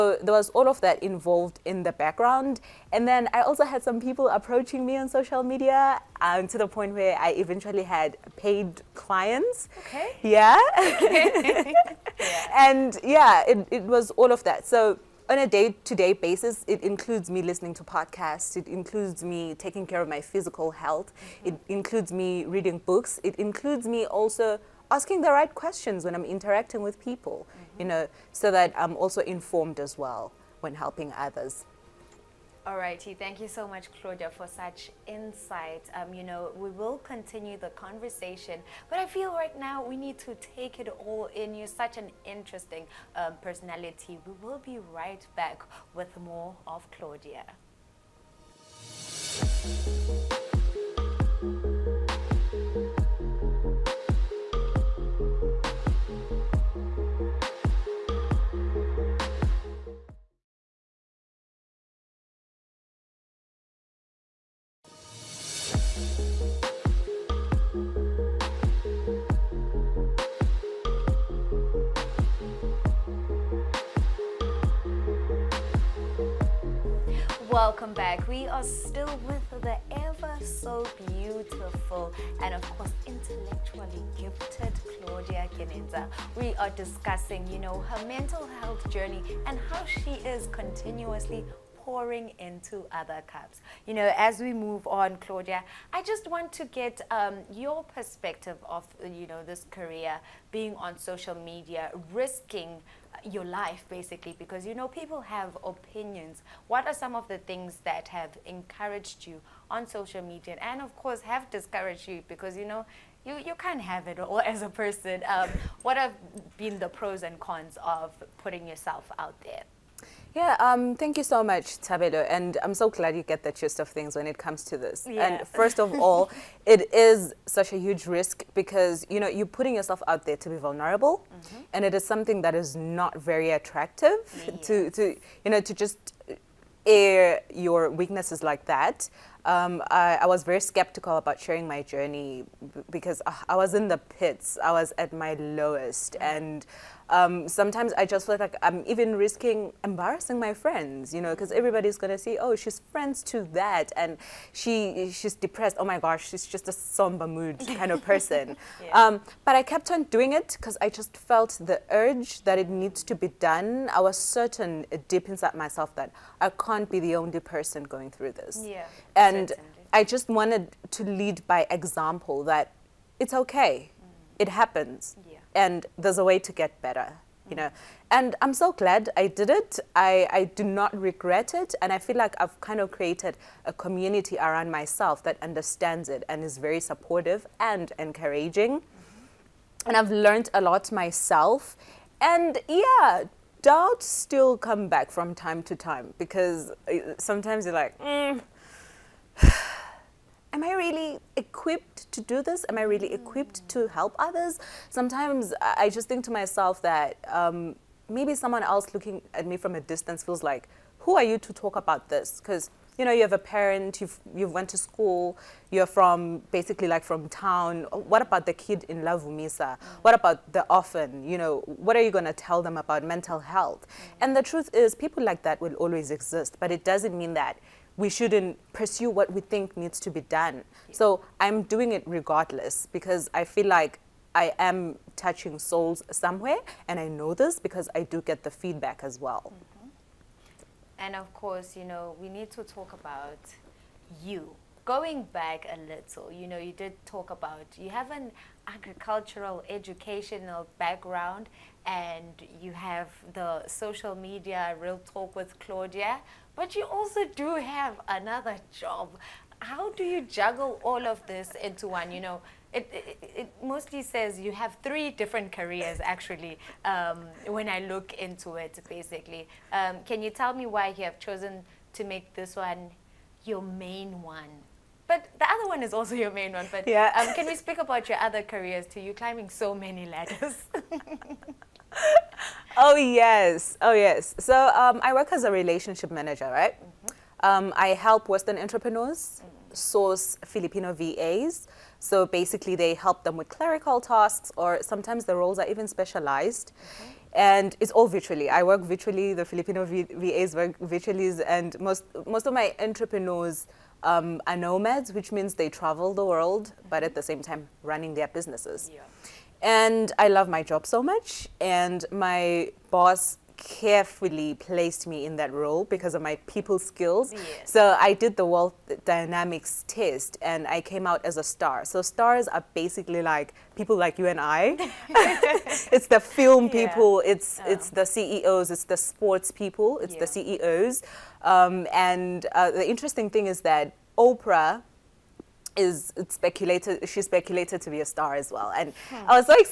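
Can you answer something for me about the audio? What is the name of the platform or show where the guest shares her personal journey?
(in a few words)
Real Talk with Claudia.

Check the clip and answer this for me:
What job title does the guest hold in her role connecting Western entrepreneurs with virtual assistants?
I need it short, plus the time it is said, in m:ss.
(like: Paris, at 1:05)
Relationship manager, at 4:45.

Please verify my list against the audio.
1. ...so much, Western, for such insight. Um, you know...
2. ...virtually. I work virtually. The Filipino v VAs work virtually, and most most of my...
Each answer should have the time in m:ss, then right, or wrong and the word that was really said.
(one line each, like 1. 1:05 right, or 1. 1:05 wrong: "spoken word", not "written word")
1. 0:33 wrong: "Claudia", not "Western"
2. 4:58 right.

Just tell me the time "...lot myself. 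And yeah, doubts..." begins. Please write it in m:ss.
3:10.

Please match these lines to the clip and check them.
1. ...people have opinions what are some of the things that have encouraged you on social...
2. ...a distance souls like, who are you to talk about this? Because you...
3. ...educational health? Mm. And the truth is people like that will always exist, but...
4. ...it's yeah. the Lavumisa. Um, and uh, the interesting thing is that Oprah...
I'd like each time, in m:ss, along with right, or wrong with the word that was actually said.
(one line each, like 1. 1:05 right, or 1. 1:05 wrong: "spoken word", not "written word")
1. 1:44 right
2. 3:29 wrong: "feels", not "souls"
3. 3:43 wrong: "mental", not "educational"
4. 5:29 wrong: "CEOs", not "Lavumisa".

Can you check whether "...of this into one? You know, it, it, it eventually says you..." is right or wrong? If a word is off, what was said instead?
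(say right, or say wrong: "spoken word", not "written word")
wrong: "mostly", not "eventually".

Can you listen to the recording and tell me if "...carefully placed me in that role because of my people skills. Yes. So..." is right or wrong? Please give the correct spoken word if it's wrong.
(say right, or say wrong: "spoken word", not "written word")
right.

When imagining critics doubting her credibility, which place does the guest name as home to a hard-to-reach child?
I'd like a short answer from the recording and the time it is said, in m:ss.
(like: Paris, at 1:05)
Lavumisa, at 3:38.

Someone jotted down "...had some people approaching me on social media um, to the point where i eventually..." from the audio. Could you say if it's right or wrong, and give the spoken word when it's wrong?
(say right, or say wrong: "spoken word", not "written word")
right.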